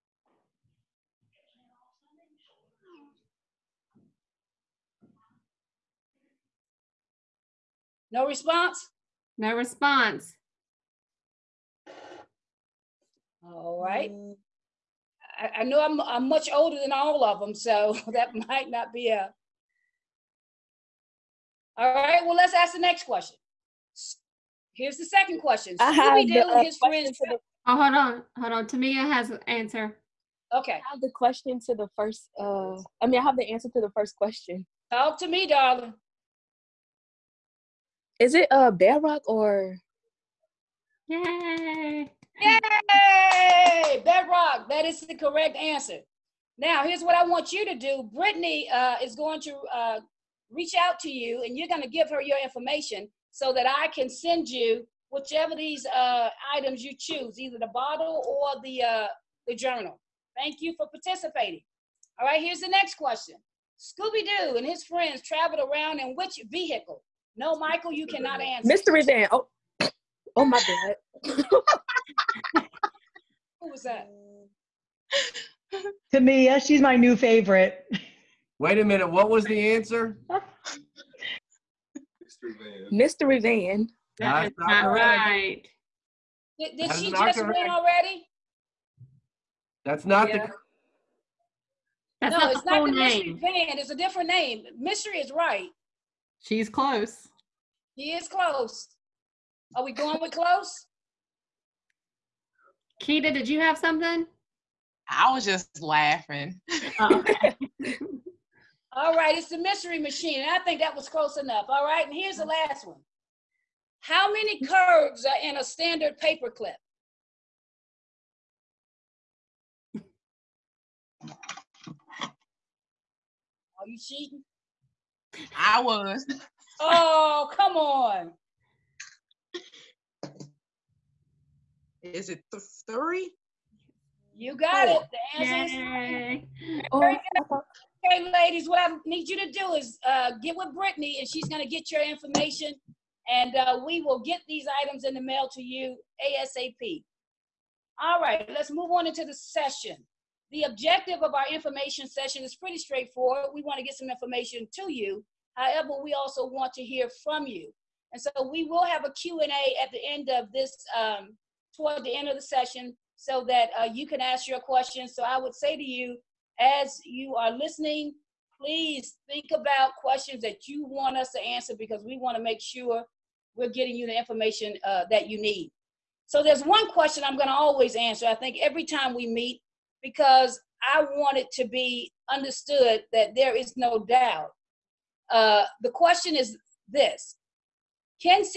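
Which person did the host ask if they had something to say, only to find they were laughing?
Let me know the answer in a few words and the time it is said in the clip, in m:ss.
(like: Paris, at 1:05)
Keita, at 1:43.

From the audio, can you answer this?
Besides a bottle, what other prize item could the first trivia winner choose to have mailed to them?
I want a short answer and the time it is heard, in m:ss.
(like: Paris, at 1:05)
Journal, at 0:59.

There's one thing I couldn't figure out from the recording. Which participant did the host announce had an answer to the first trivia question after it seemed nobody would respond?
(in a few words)
Tamia.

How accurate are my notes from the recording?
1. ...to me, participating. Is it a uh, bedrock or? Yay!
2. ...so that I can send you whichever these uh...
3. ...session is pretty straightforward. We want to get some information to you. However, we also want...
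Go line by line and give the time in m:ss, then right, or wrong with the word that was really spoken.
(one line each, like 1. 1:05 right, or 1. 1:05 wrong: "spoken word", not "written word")
1. 0:35 wrong: "darling", not "participating"
2. 0:53 right
3. 2:32 right.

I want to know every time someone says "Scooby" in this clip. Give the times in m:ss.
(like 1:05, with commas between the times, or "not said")
0:25, 1:03.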